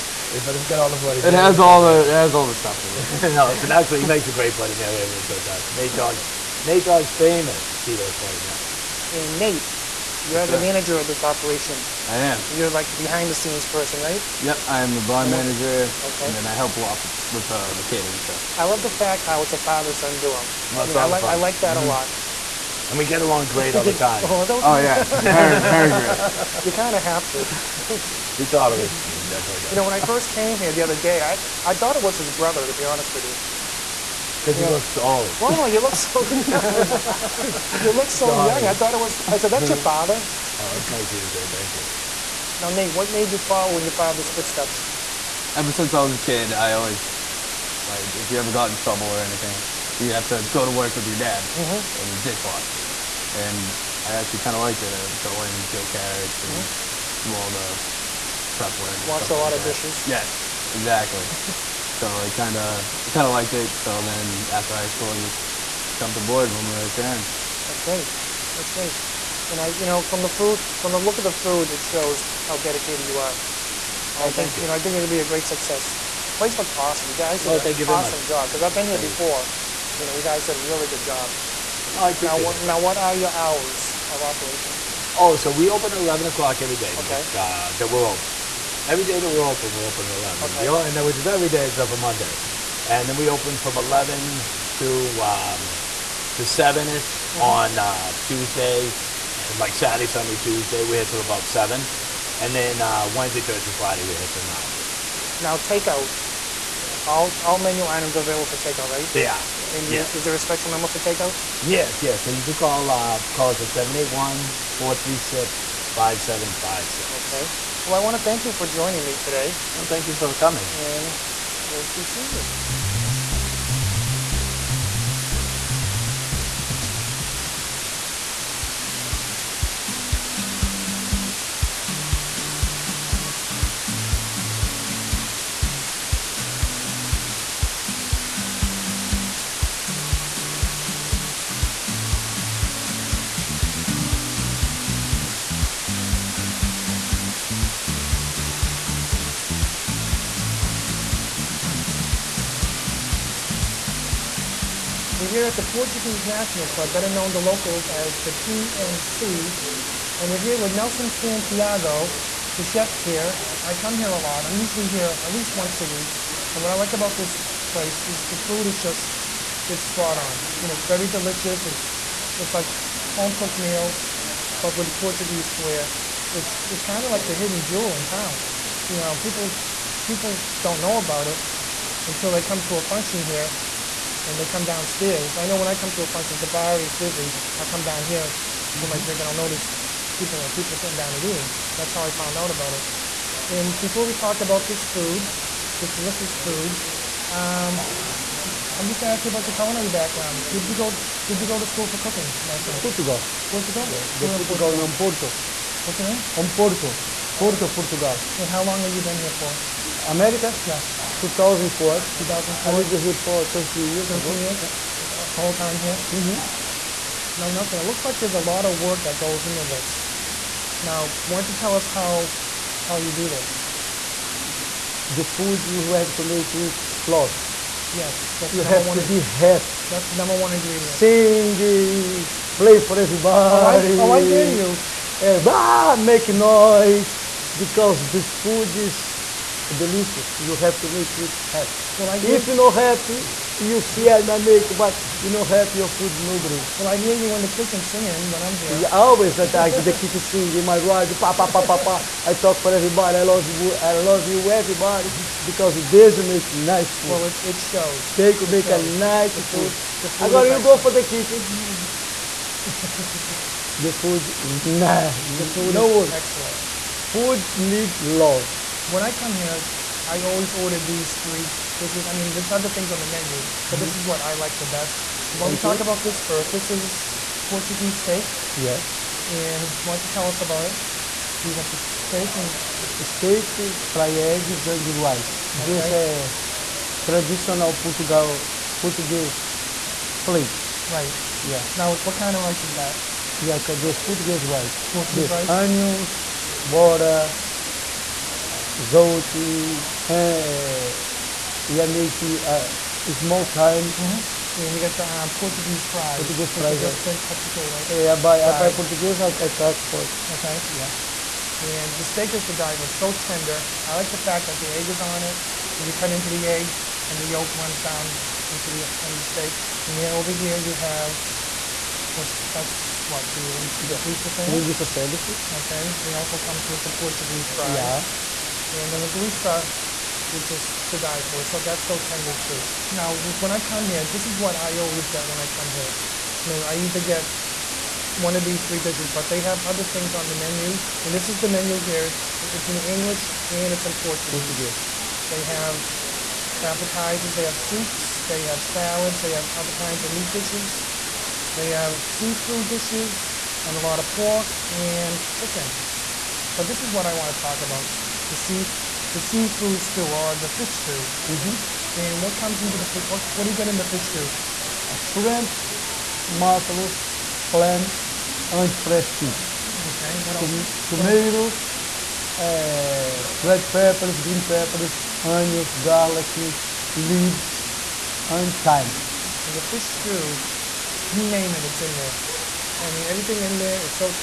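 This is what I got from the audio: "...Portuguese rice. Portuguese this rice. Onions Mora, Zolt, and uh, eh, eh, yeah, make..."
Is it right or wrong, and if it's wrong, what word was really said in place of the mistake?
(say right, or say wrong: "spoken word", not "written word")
right.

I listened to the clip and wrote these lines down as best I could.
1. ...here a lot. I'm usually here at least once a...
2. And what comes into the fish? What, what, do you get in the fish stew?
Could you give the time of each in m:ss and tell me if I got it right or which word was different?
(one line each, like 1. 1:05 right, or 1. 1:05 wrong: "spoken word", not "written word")
1. 2:43 right
2. 6:01 right.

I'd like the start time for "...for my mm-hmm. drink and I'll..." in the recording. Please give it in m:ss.
3:08.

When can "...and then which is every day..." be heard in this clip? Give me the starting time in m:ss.
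1:30.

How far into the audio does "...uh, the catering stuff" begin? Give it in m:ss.
0:17.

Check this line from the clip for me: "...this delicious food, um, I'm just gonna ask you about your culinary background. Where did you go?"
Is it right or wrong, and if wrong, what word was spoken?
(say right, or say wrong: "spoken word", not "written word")
right.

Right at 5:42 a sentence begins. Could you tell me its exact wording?
It's in English and it's in Portuguese.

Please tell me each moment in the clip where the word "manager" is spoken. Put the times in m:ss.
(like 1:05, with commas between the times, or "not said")
0:10, 0:15.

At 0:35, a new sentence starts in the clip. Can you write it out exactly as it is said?
Well, no, you look so young.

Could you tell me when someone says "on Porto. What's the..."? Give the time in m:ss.
3:24.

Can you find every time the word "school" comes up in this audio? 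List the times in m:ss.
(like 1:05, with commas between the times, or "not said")
1:04, 3:21.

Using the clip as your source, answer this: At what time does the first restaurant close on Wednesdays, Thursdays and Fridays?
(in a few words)
9.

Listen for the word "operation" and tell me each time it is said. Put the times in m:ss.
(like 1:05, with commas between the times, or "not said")
0:11, 1:24.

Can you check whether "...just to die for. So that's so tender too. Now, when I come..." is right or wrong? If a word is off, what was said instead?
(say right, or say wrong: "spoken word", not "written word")
right.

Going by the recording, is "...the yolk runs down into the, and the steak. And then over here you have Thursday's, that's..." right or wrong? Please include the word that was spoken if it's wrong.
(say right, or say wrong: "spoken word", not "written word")
wrong: "What", not "Thursday".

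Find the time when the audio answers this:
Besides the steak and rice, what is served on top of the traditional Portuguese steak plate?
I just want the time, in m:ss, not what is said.
4:43.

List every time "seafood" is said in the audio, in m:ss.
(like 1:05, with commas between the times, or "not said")
5:52, 5:59.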